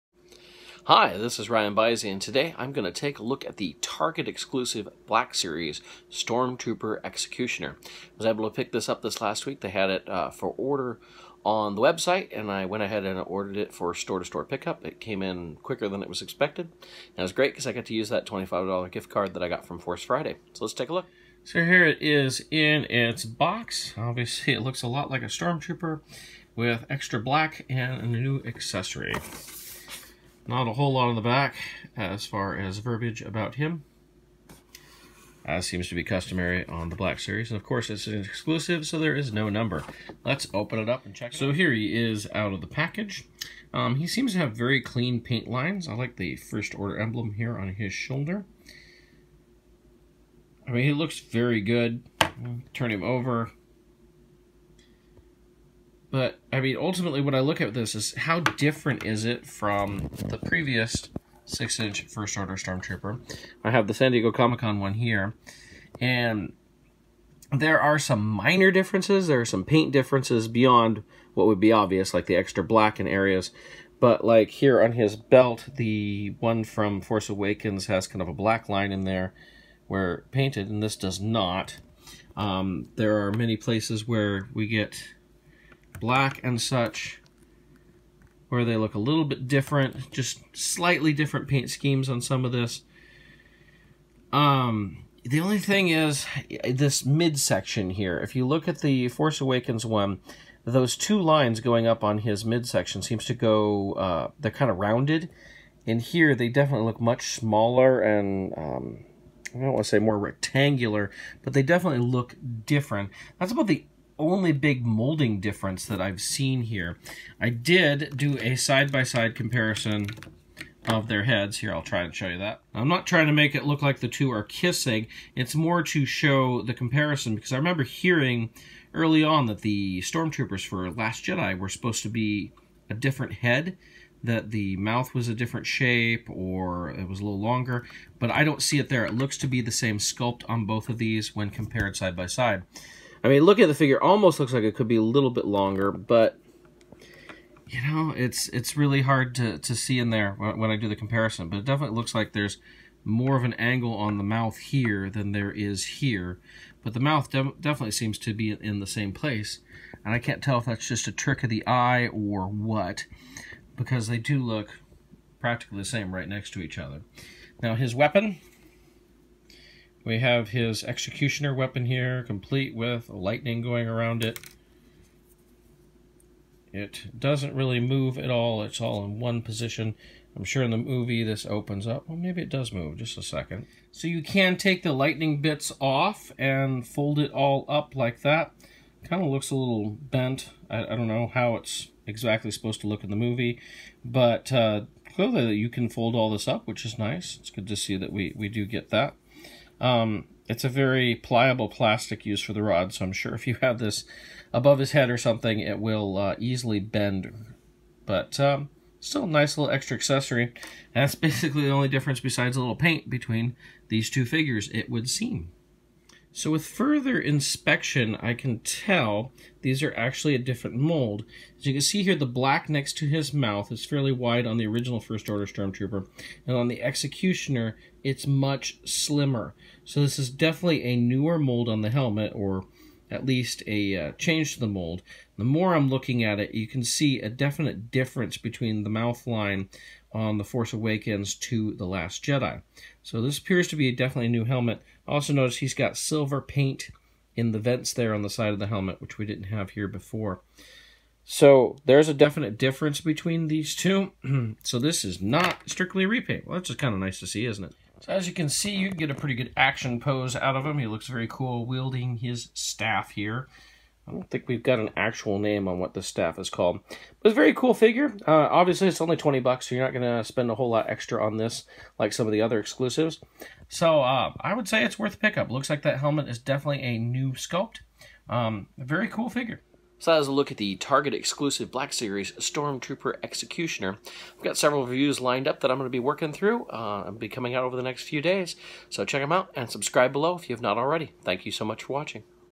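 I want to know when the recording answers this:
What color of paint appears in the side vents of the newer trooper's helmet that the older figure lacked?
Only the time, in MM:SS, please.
04:05.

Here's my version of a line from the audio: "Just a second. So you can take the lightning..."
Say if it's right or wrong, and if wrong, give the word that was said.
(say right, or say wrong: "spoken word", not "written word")
right.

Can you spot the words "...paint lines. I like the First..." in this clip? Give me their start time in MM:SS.
00:45.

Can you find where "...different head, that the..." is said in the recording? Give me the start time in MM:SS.
02:12.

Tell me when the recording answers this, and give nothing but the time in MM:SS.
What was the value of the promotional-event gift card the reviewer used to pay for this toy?
00:18.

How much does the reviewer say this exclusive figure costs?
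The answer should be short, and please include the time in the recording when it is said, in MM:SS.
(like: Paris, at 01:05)
$20, at 04:29.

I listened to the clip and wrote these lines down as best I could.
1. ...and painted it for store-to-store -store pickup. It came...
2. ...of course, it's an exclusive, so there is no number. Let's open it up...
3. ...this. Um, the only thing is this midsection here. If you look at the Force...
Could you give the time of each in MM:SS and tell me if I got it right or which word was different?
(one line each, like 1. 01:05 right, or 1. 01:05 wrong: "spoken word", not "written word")
1. 00:13 wrong: "ordered", not "painted"
2. 00:37 right
3. 01:32 right.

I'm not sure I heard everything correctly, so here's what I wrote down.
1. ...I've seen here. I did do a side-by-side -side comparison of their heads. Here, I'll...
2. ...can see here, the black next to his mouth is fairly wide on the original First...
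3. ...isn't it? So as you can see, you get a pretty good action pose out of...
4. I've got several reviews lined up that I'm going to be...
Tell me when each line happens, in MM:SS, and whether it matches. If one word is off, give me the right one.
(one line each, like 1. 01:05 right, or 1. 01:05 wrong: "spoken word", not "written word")
1. 01:55 right
2. 03:41 right
3. 04:17 right
4. 04:44 right.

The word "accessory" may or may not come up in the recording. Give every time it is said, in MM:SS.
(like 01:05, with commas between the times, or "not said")
00:28, 03:29.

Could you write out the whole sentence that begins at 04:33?
So uh, I would say it's worth pickup.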